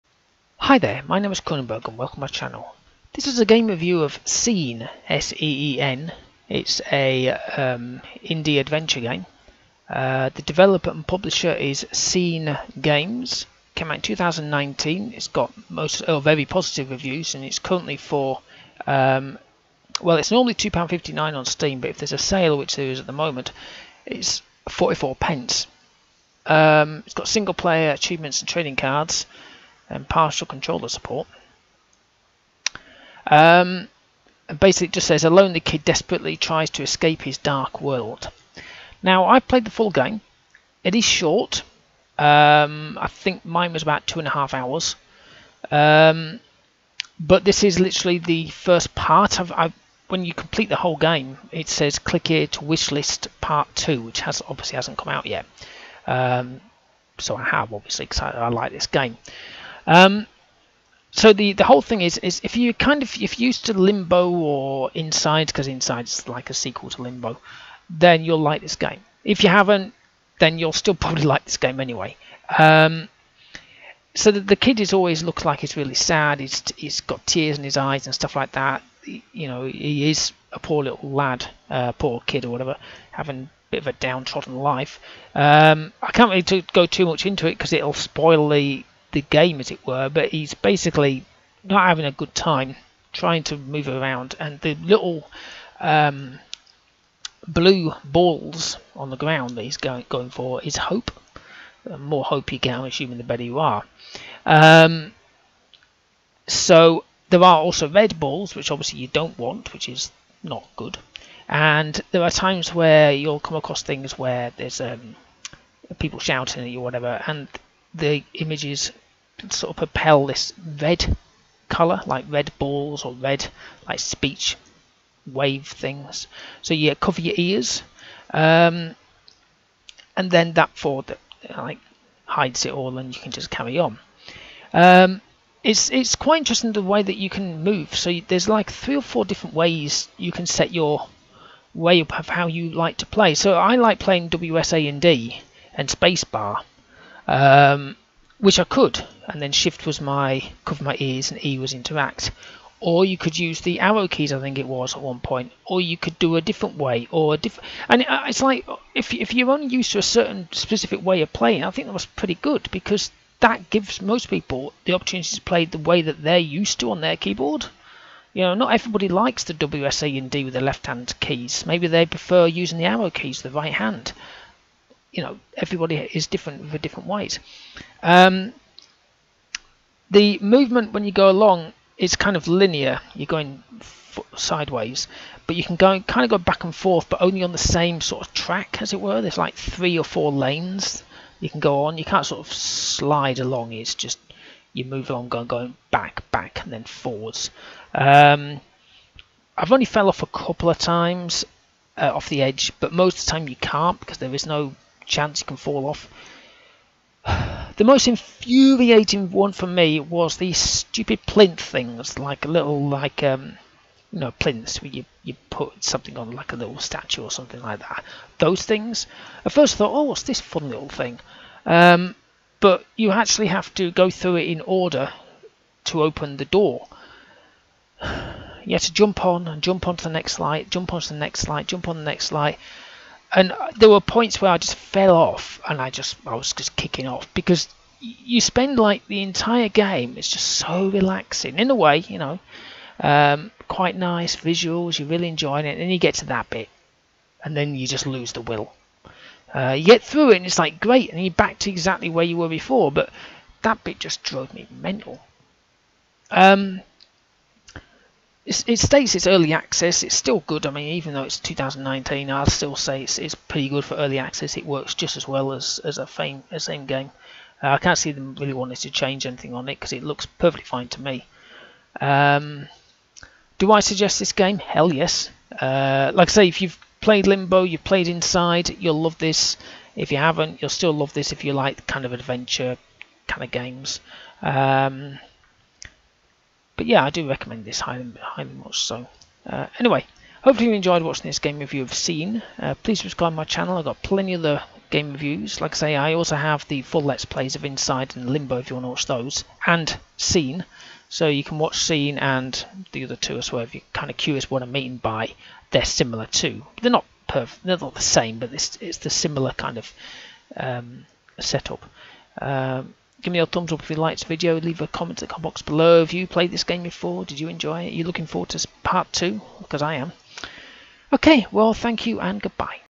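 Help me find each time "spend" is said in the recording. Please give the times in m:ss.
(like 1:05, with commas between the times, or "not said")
3:58.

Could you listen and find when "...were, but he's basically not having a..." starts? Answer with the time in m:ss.
1:29.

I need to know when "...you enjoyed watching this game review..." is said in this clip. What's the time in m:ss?
4:50.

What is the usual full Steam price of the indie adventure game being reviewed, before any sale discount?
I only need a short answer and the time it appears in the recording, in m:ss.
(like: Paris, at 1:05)
£2.59, at 0:20.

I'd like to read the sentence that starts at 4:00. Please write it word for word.
It's just so relaxing in a way, you know.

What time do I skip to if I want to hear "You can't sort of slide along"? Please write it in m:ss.
3:11.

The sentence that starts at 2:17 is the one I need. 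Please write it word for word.
So there's like three or four different ways you can set your way of how you like to play.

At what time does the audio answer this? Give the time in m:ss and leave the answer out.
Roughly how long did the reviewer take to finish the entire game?
0:44.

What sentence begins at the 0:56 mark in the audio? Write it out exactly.
Um, so I have obviously because I, I, like this game.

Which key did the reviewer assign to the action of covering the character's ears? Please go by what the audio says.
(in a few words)
Shift.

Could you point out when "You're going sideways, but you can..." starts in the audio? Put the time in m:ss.
3:03.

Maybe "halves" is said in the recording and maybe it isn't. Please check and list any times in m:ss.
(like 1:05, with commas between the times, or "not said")
not said.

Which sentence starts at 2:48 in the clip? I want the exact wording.
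You know, not everybody likes the WSA and D with the left hand keys.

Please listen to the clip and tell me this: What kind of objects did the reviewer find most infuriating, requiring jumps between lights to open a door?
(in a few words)
Plinths.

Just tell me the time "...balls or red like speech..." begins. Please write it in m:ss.
2:02.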